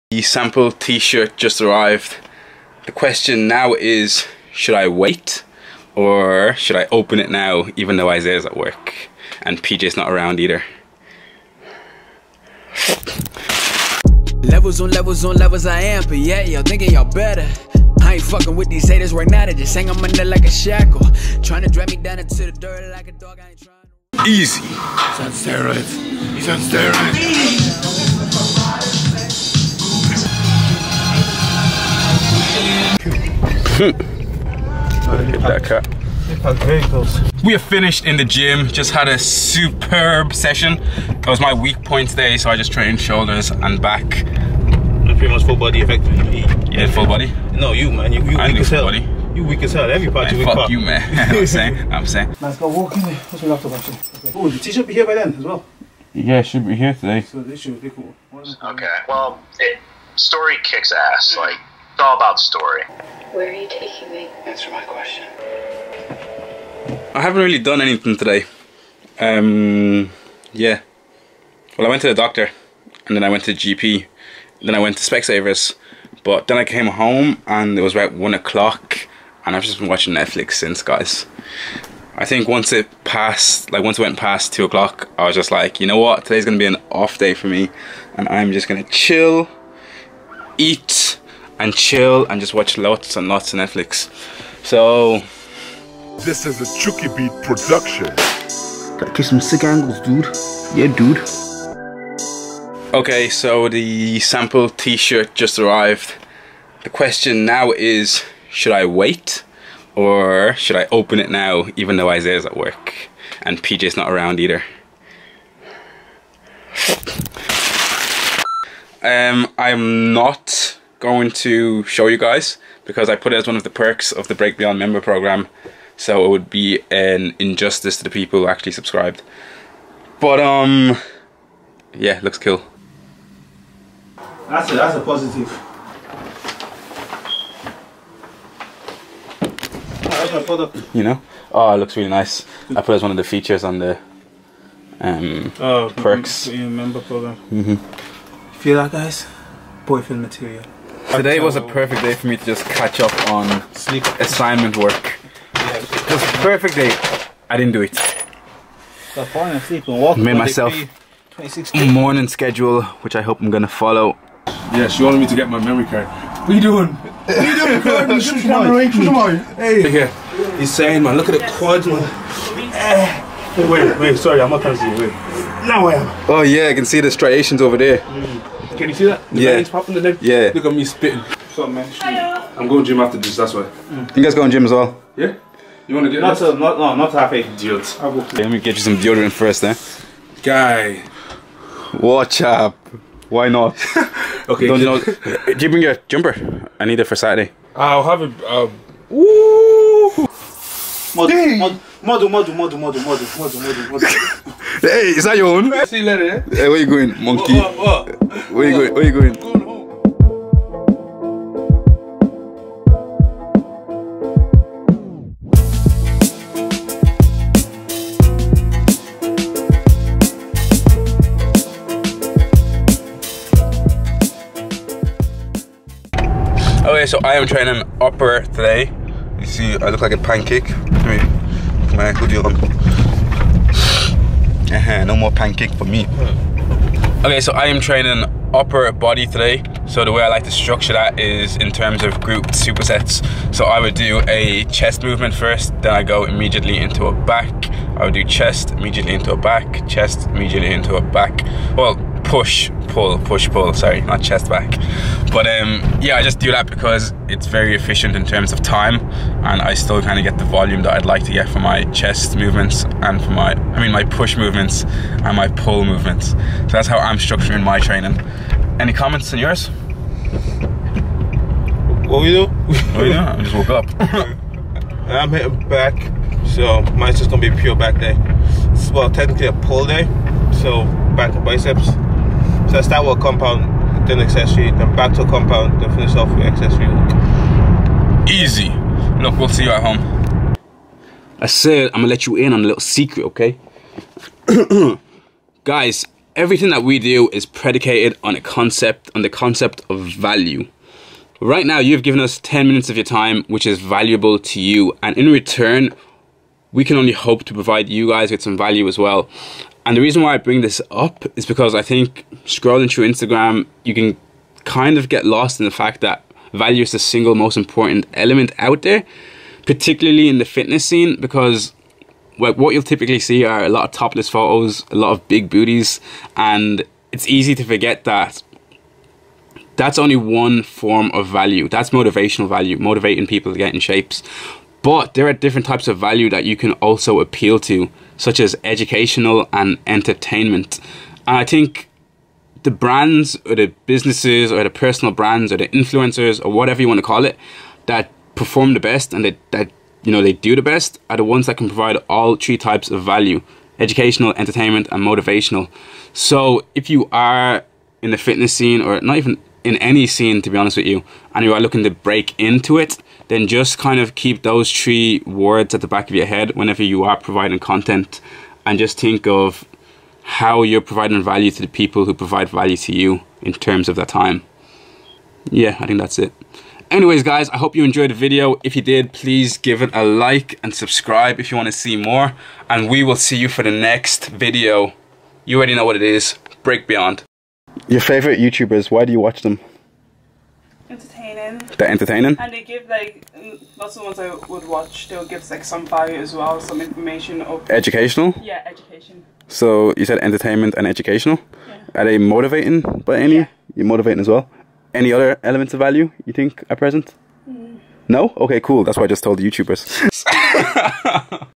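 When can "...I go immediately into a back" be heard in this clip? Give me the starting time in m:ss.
4:05.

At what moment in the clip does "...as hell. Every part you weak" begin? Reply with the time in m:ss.
0:49.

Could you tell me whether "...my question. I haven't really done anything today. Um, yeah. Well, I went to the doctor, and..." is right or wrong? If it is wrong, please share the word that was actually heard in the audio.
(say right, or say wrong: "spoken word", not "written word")
right.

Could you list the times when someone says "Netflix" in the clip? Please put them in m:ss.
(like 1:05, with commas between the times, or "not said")
1:20, 1:33.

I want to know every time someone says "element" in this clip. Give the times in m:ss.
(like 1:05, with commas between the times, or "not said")
5:18, 6:45.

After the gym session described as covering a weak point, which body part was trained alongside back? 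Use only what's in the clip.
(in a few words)
Shoulders.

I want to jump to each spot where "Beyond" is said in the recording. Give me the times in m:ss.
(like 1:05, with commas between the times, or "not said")
2:04, 6:26.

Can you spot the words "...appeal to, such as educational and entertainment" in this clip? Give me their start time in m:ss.
5:37.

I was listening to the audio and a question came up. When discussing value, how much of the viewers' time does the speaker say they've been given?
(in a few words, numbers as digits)
10 minutes.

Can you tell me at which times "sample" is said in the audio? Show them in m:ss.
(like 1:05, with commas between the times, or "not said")
0:00, 1:44.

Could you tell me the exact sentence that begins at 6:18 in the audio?
If you did, please give it a like and subscribe if you want to see more.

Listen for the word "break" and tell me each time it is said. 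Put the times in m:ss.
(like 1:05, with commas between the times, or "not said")
2:04, 6:01, 6:26.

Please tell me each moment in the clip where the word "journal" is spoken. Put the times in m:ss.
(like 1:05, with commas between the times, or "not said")
not said.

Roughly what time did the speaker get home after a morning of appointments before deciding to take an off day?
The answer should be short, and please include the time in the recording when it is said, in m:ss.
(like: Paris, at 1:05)
1 o'clock, at 1:18.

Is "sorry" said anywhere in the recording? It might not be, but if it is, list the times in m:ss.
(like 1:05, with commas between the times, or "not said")
2:54, 4:13.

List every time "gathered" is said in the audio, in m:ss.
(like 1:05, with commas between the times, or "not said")
not said.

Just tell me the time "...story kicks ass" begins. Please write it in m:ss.
1:00.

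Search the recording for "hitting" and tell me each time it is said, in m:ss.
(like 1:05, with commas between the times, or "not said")
4:35.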